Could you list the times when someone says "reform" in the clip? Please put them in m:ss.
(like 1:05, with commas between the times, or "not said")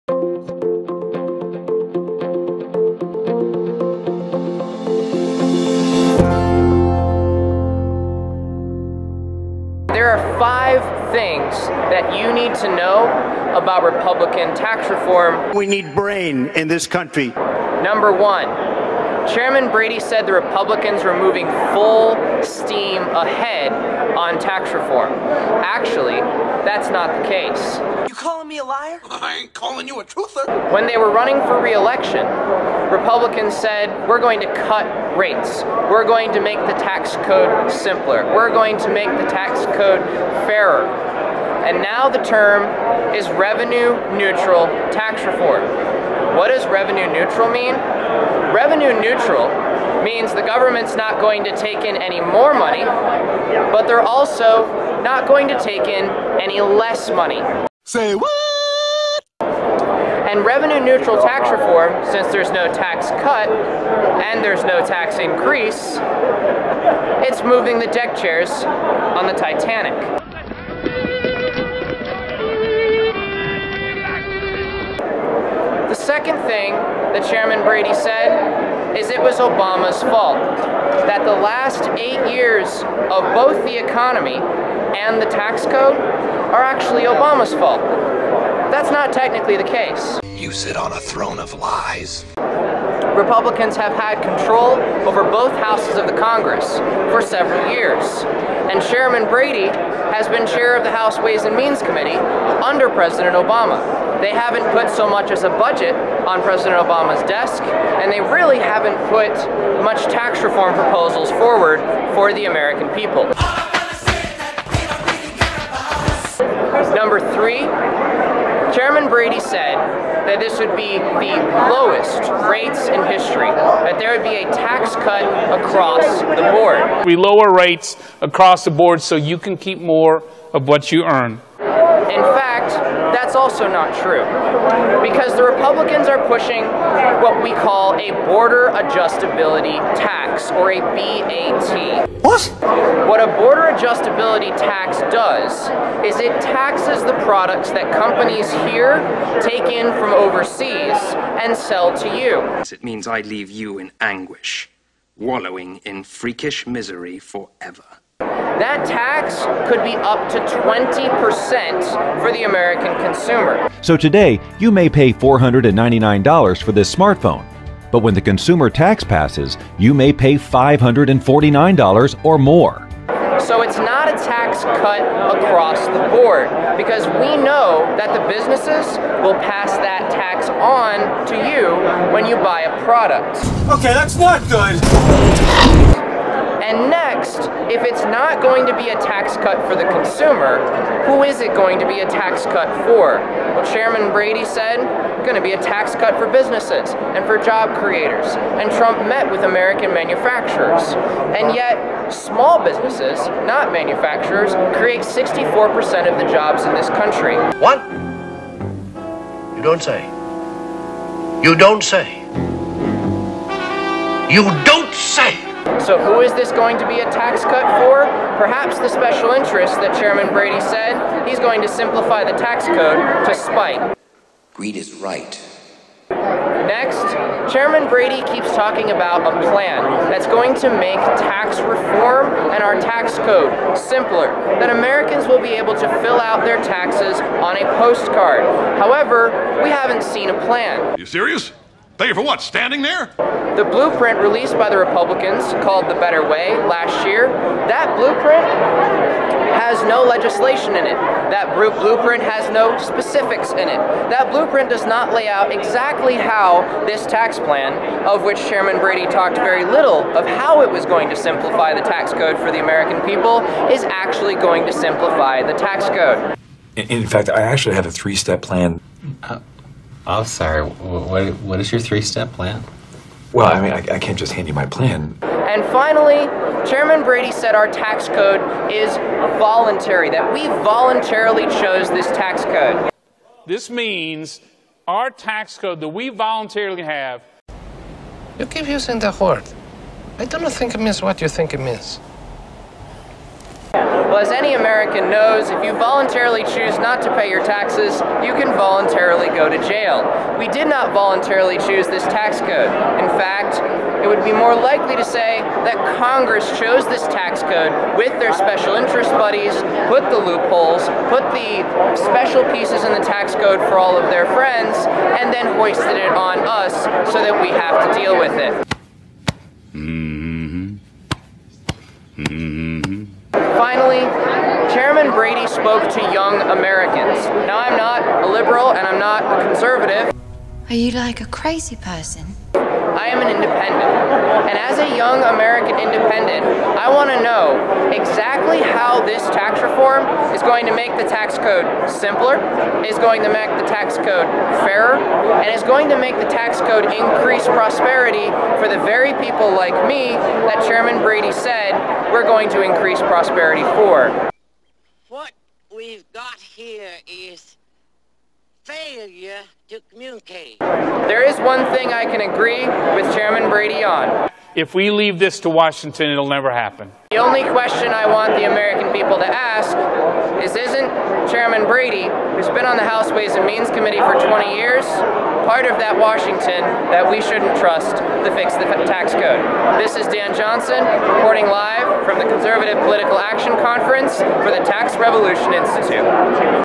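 0:14, 0:24, 0:45, 1:01, 1:50, 3:51, 5:39.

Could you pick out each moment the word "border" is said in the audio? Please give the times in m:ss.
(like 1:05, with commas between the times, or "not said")
2:18, 2:23.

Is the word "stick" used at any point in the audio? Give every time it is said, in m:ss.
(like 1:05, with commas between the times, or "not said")
not said.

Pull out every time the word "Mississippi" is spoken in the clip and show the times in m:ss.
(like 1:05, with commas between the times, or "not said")
not said.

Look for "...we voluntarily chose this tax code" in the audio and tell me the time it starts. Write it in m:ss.
4:40.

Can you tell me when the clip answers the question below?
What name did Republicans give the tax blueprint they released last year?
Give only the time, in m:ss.
4:05.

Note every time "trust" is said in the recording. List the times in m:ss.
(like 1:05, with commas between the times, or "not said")
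6:17.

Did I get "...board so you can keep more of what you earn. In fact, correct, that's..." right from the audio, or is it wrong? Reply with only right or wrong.
right.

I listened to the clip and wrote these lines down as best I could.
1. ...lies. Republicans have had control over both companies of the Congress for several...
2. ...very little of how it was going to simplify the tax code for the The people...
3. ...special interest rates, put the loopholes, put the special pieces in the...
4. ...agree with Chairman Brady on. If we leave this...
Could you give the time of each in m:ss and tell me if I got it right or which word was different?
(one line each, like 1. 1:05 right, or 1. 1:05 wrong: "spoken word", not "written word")
1. 1:31 wrong: "houses", not "companies"
2. 4:19 wrong: "American", not "The"
3. 5:08 wrong: "buddies", not "rates"
4. 6:02 right.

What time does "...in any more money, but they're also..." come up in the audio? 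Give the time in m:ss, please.
0:51.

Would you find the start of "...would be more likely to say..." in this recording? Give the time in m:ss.
5:04.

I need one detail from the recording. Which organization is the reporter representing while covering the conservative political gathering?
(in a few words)
Tax Revolution Institute.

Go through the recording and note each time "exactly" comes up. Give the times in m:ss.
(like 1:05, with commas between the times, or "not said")
4:15, 5:37.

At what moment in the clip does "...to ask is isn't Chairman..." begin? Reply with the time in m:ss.
6:09.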